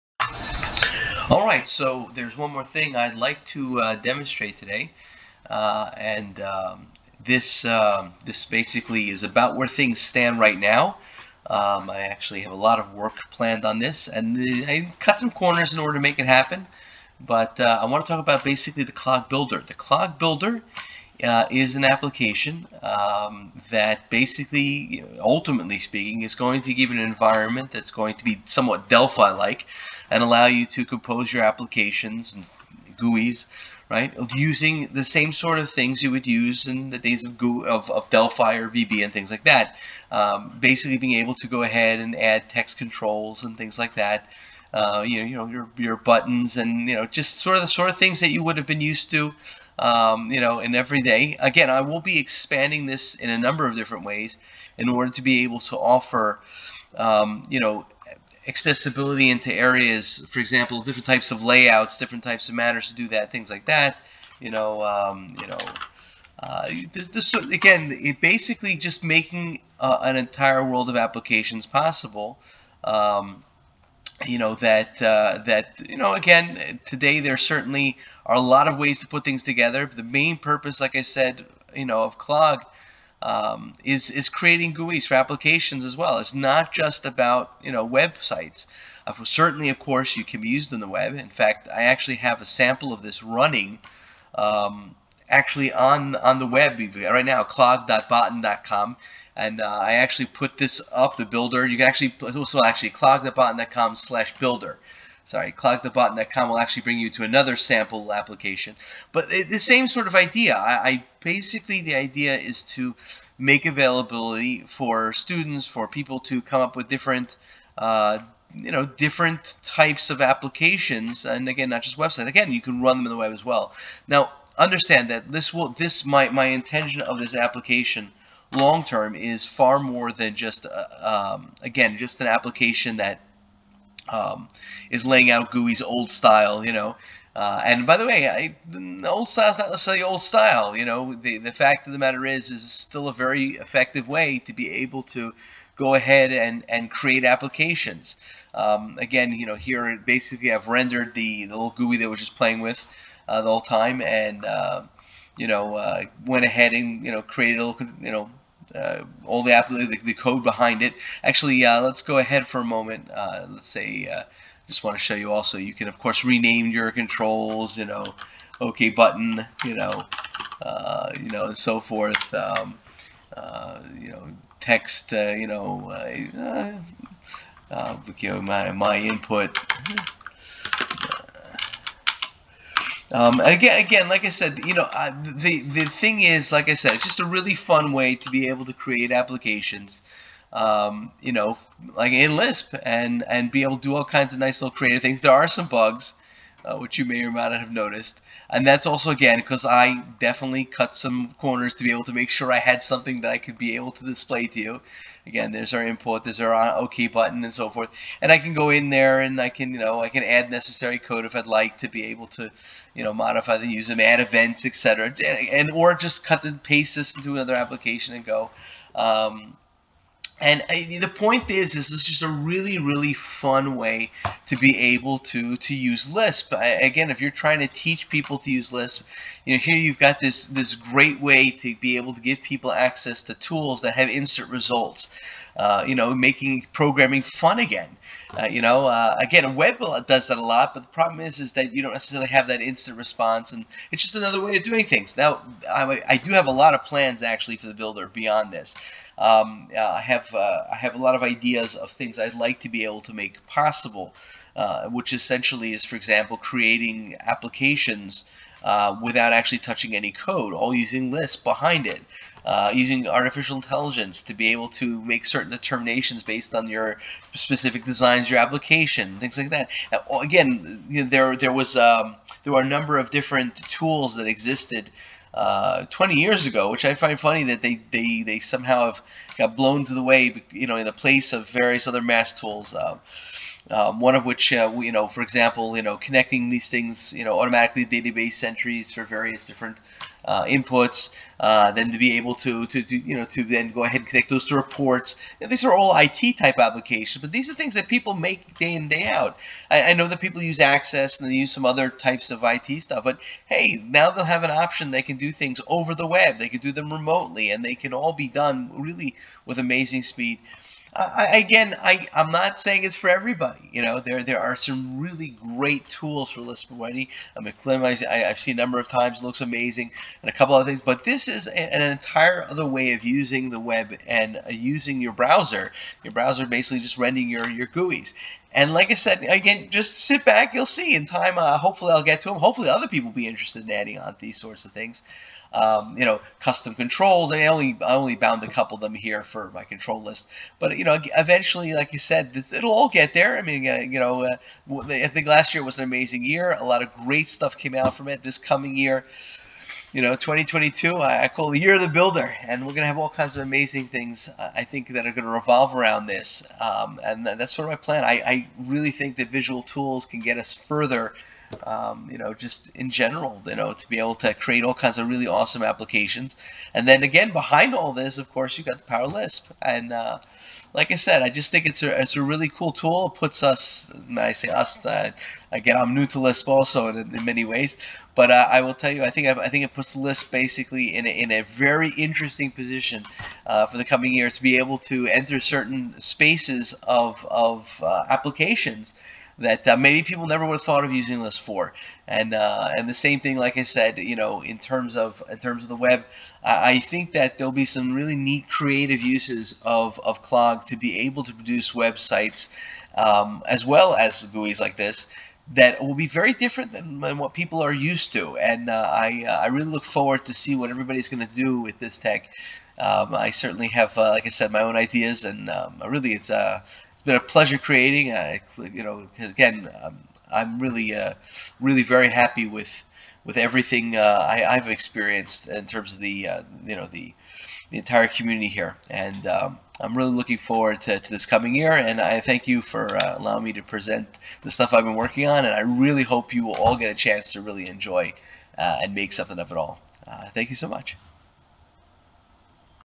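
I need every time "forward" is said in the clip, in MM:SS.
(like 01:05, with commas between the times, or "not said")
06:49, 07:10.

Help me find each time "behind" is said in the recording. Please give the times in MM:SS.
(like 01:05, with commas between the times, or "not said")
02:40, 04:21, 06:07.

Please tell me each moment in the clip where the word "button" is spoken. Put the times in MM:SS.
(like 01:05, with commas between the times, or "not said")
00:45, 02:48, 03:27.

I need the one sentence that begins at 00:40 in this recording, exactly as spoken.
Um, basically being able to go ahead and add text controls and things like that.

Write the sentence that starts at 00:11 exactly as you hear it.
Um, I actually have a lot of work planned on this, and I cut some corners in order to make it happen.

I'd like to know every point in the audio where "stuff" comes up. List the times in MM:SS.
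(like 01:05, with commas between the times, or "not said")
05:02, 05:47, 07:14.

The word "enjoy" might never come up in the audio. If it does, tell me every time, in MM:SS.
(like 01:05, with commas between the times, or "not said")
07:17.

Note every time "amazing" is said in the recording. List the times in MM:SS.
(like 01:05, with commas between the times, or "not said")
05:09, 05:19, 05:45, 05:53.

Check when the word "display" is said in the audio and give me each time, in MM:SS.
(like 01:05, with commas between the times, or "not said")
03:24.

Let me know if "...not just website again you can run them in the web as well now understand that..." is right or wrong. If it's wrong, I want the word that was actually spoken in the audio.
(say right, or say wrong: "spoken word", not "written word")
right.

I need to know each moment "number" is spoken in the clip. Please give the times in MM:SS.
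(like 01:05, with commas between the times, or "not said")
00:53, 04:32, 05:18.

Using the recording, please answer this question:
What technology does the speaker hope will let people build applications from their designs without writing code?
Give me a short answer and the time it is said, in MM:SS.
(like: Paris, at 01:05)
artificial intelligence, at 04:23.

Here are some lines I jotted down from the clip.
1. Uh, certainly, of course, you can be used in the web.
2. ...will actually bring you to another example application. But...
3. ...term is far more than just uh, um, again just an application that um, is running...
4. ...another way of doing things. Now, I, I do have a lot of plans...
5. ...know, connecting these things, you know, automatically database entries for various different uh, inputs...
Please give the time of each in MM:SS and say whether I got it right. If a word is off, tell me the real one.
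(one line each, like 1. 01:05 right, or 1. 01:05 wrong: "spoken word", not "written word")
1. 01:29 right
2. 01:46 wrong: "sample", not "example"
3. 02:08 wrong: "laying", not "running"
4. 04:04 right
5. 04:45 right.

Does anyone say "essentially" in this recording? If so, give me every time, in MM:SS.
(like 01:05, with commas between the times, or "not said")
04:15.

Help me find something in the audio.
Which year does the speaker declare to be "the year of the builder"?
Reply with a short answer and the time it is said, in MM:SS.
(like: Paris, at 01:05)
2022, at 05:50.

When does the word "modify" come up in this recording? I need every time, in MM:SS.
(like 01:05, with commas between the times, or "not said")
03:33.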